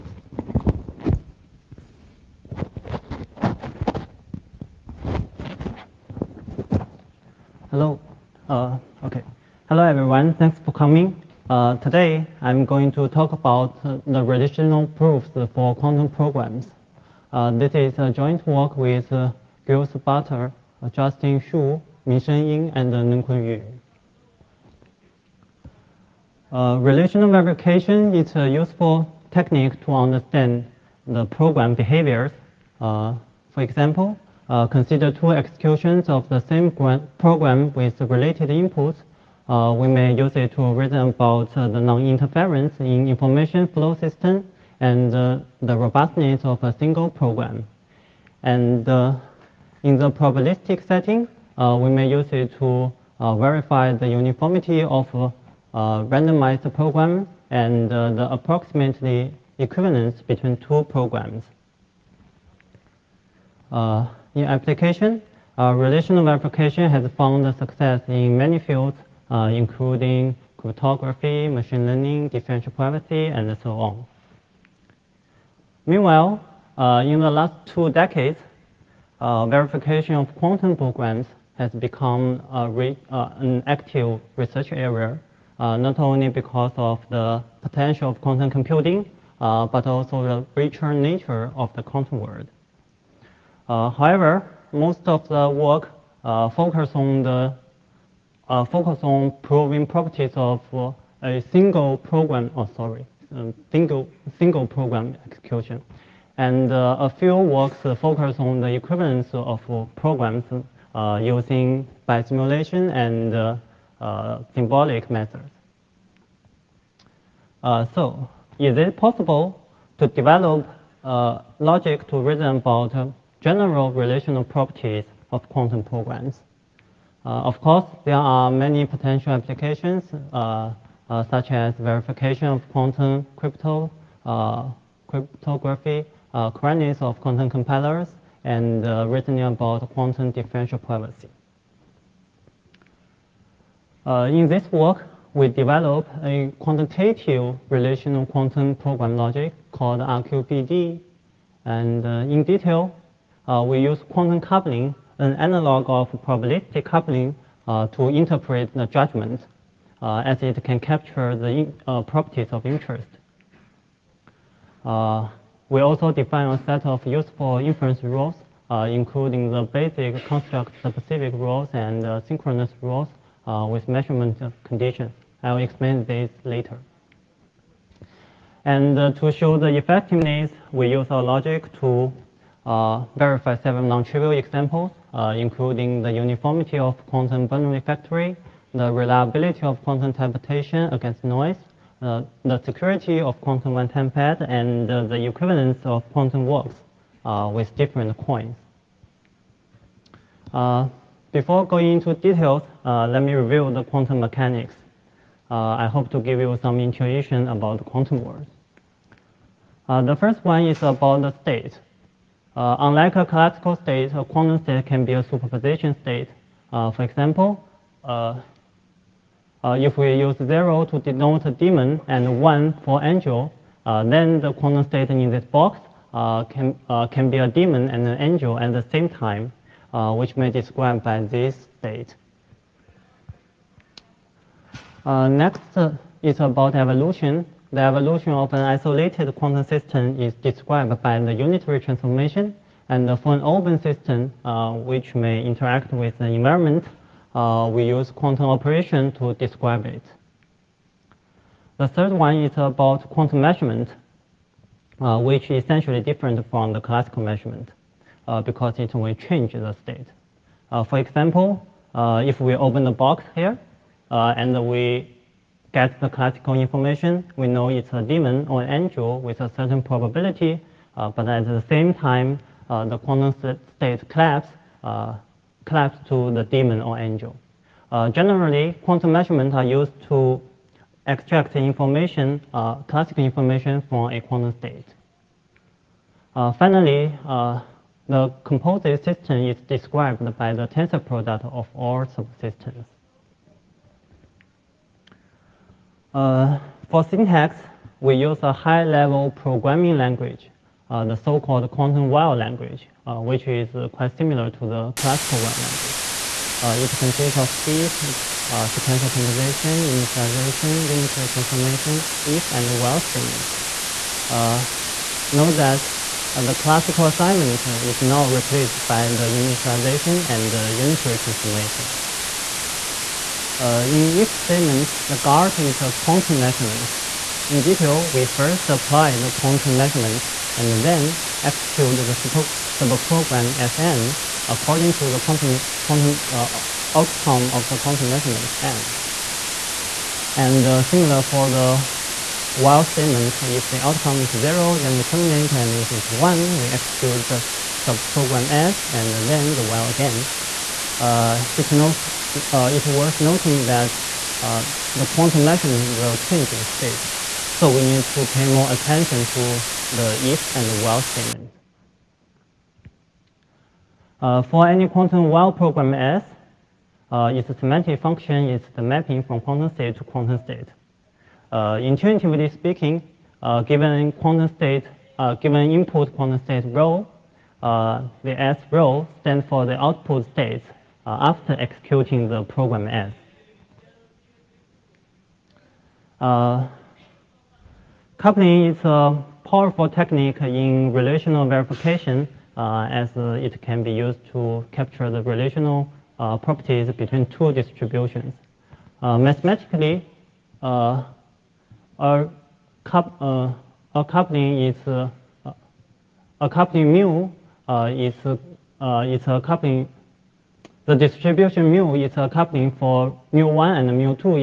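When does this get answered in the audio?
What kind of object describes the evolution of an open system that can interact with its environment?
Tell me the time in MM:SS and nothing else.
04:08.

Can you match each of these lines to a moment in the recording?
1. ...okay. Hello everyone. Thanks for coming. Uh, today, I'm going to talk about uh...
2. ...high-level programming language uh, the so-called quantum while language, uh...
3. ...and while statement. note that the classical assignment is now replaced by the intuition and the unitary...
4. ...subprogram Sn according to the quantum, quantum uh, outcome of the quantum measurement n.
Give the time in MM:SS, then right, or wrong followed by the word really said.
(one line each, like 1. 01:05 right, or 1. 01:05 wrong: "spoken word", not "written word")
1. 00:09 right
2. 04:58 right
3. 05:12 wrong: "initialization", not "intuition"
4. 05:32 right.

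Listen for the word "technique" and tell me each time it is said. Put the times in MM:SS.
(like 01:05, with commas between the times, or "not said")
00:29, 06:29.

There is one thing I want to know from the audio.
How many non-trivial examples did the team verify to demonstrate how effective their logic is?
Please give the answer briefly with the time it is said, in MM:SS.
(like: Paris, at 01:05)
7, at 03:03.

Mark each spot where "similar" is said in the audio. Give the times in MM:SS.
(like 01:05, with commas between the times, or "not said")
05:04, 05:40.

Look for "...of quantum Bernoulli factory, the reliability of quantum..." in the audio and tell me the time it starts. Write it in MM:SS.
03:06.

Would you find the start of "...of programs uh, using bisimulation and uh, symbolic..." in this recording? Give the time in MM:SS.
01:49.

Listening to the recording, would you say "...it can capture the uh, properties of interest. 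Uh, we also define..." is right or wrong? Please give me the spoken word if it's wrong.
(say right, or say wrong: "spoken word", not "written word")
right.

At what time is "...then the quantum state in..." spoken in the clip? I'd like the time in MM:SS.
03:44.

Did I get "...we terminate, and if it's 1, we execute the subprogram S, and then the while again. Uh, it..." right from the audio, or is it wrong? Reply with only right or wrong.
right.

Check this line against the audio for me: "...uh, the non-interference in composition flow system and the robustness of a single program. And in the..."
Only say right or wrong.
wrong.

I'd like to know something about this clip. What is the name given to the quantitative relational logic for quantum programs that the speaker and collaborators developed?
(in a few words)
RQPD.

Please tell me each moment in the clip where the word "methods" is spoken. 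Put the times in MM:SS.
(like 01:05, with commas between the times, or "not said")
01:55.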